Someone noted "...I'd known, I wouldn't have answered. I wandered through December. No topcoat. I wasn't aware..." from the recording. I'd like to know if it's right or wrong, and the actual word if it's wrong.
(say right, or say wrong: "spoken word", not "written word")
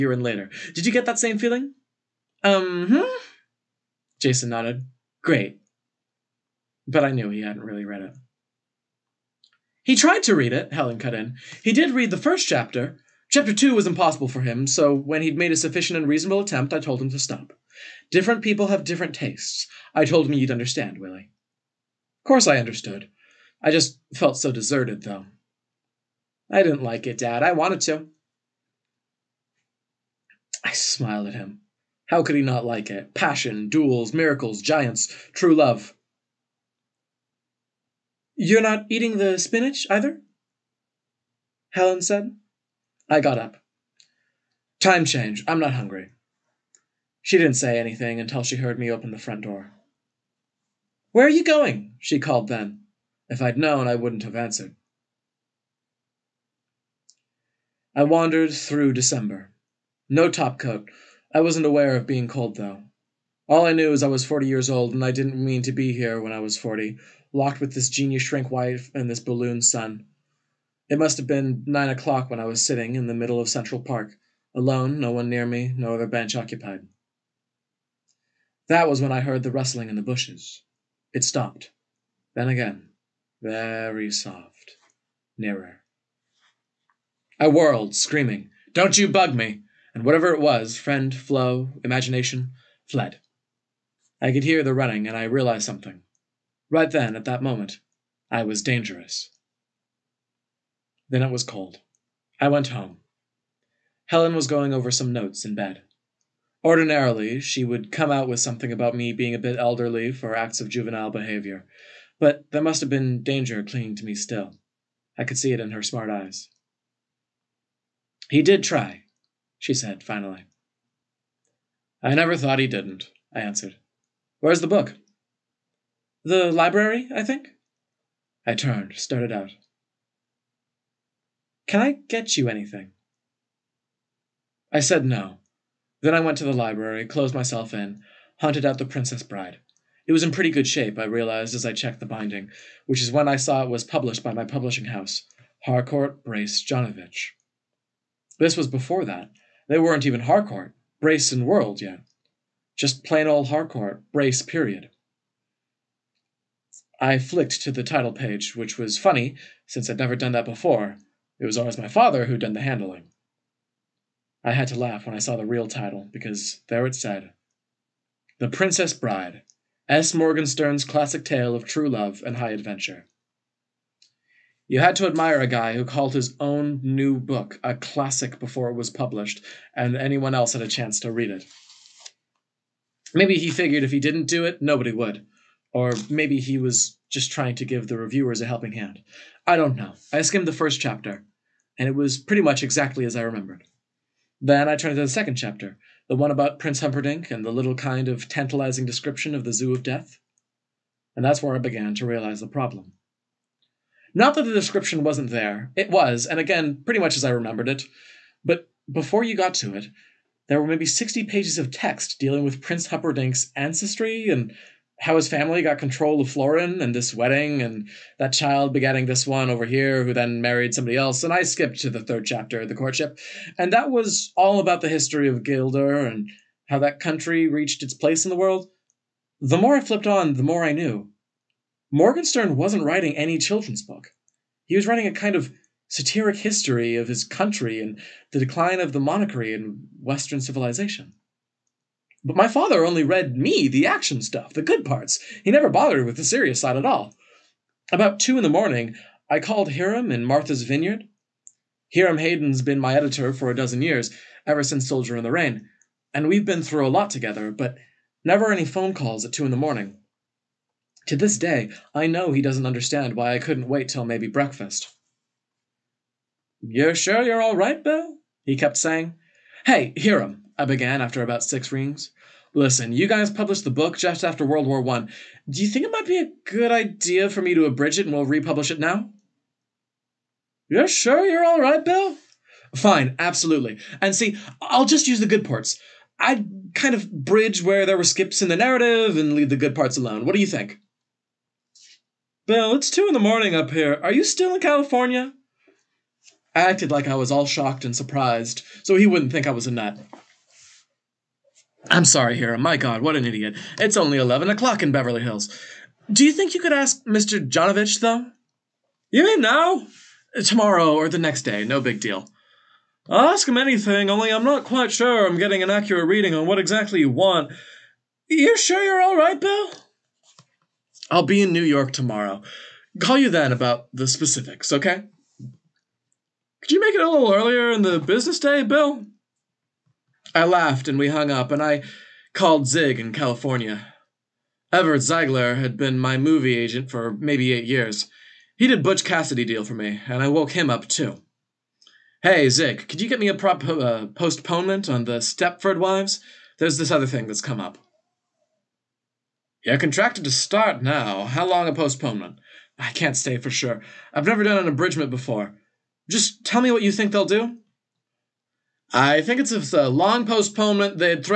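right.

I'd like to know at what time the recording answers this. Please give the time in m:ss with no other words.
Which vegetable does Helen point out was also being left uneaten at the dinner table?
0:39.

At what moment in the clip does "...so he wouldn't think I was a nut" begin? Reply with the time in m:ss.
4:58.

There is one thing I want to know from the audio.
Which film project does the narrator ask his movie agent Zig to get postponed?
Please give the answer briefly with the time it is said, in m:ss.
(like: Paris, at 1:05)
The Stepford Wives, at 5:45.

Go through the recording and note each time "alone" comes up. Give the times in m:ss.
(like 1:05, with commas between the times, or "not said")
1:14, 4:49.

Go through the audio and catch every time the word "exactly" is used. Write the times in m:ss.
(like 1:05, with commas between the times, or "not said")
3:12, 5:16.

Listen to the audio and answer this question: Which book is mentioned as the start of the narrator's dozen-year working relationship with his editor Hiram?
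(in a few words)
Soldier in the Rain.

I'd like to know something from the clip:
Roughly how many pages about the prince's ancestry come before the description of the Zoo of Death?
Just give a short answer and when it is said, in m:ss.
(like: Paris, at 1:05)
60, at 3:30.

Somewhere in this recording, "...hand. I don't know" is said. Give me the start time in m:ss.
3:08.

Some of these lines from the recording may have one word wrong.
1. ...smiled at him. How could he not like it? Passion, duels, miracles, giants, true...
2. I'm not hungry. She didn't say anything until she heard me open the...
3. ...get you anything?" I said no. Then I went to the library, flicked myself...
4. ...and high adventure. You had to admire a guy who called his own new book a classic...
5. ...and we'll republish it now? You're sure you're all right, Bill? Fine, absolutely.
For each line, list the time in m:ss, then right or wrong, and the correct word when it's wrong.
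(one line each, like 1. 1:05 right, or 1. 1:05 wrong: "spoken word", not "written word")
1. 0:30 right
2. 0:45 right
3. 2:12 wrong: "closed", not "flicked"
4. 2:52 right
5. 4:38 right.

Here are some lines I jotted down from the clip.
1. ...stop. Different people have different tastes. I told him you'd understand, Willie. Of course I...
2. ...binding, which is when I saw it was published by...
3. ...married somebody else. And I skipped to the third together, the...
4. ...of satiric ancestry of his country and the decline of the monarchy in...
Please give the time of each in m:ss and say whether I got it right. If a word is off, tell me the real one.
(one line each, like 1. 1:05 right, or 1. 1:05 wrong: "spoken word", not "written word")
1. 0:17 right
2. 2:22 right
3. 3:40 wrong: "chapter", not "together"
4. 3:55 wrong: "history", not "ancestry".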